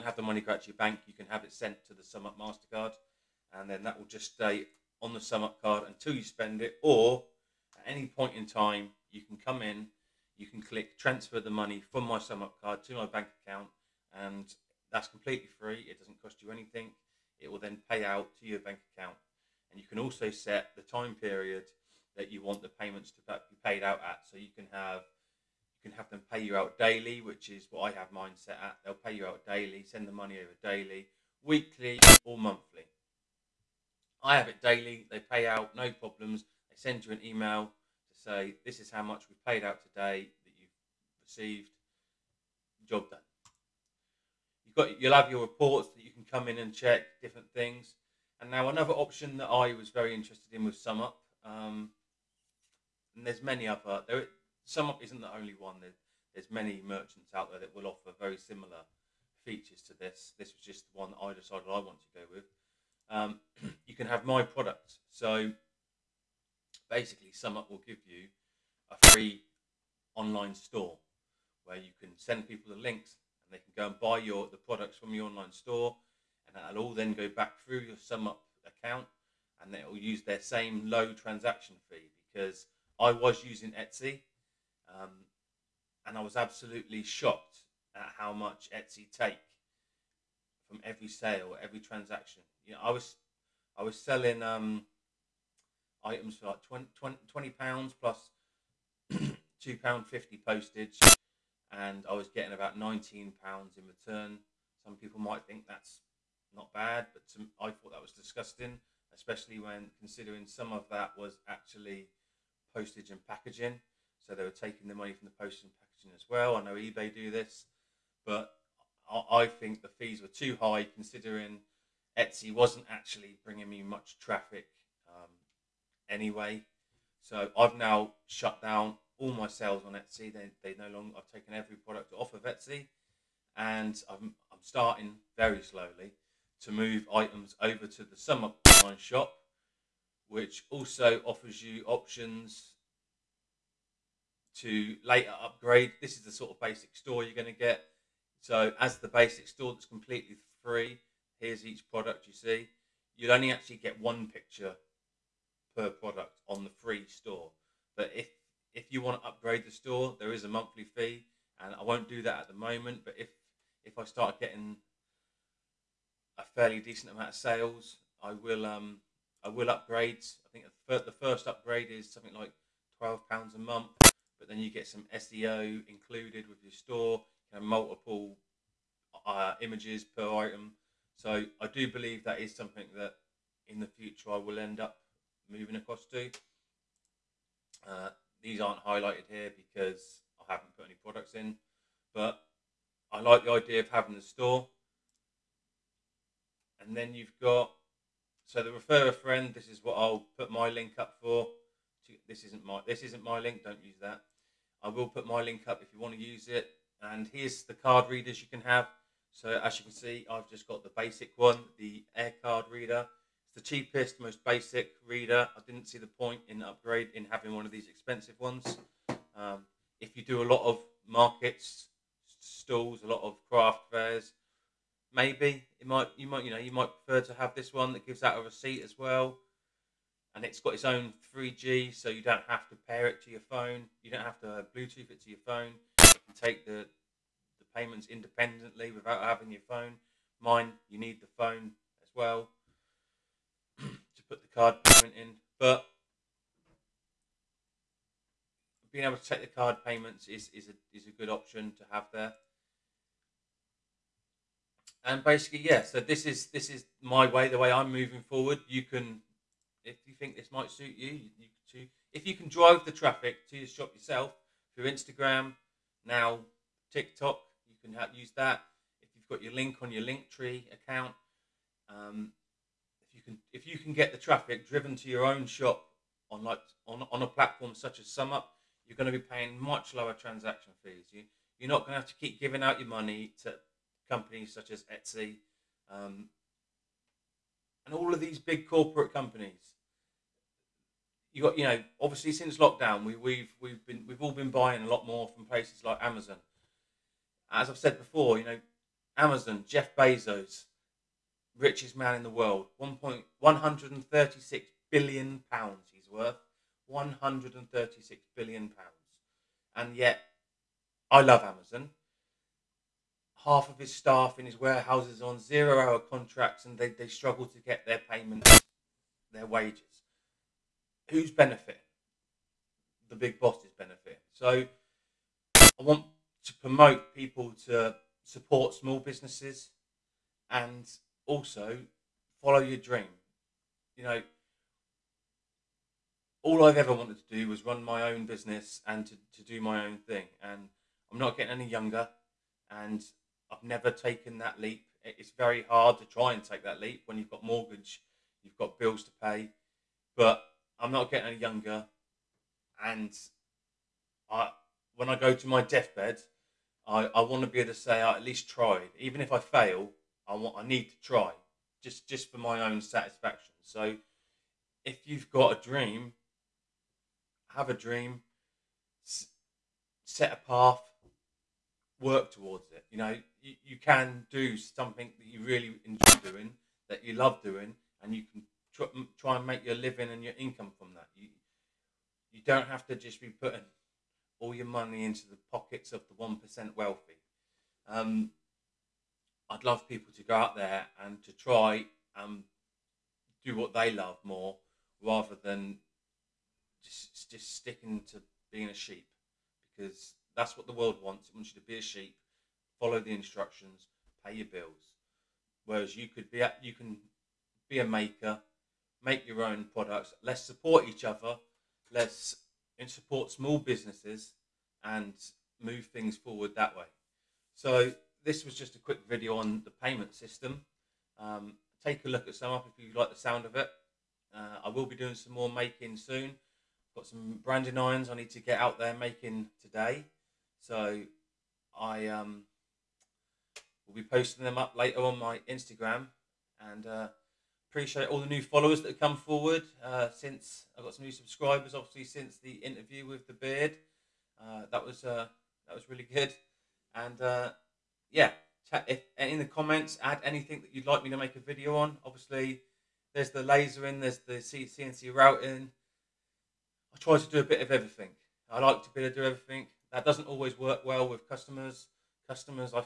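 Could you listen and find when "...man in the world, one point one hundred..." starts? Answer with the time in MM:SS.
05:01.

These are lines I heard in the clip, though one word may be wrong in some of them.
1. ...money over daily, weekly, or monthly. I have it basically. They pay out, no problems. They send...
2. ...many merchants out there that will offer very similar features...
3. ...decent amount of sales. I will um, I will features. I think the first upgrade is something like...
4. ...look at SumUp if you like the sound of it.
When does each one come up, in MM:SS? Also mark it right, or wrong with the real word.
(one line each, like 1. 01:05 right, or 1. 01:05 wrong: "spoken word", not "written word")
1. 00:30 wrong: "daily", not "basically"
2. 00:56 right
3. 02:46 wrong: "upgrades", not "features"
4. 07:02 right.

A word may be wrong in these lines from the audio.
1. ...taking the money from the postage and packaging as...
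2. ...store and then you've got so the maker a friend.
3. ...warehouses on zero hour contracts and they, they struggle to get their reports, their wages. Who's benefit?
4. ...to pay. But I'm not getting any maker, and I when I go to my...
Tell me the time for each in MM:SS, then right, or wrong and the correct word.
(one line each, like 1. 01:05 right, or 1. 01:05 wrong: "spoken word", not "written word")
1. 01:54 right
2. 03:14 wrong: "refer", not "maker"
3. 05:14 wrong: "payments", not "reports"
4. 05:49 wrong: "younger", not "maker".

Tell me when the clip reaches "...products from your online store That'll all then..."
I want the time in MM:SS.
01:14.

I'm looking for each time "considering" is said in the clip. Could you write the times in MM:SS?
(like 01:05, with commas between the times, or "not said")
01:49, 02:00.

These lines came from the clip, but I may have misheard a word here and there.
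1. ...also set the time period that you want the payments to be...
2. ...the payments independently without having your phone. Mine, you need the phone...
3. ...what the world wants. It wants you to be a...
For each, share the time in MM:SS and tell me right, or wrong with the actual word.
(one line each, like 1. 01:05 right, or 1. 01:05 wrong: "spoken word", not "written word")
1. 00:19 right
2. 03:57 right
3. 06:40 right.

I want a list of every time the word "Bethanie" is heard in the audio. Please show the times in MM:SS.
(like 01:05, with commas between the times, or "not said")
not said.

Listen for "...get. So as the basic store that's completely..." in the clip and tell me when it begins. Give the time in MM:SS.
02:27.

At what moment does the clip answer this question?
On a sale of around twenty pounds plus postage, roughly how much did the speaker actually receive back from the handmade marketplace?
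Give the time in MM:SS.
01:42.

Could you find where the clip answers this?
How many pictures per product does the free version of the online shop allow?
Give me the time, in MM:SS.
02:33.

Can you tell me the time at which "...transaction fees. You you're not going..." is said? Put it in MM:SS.
04:40.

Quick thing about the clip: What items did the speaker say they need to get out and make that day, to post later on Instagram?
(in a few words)
Branding irons.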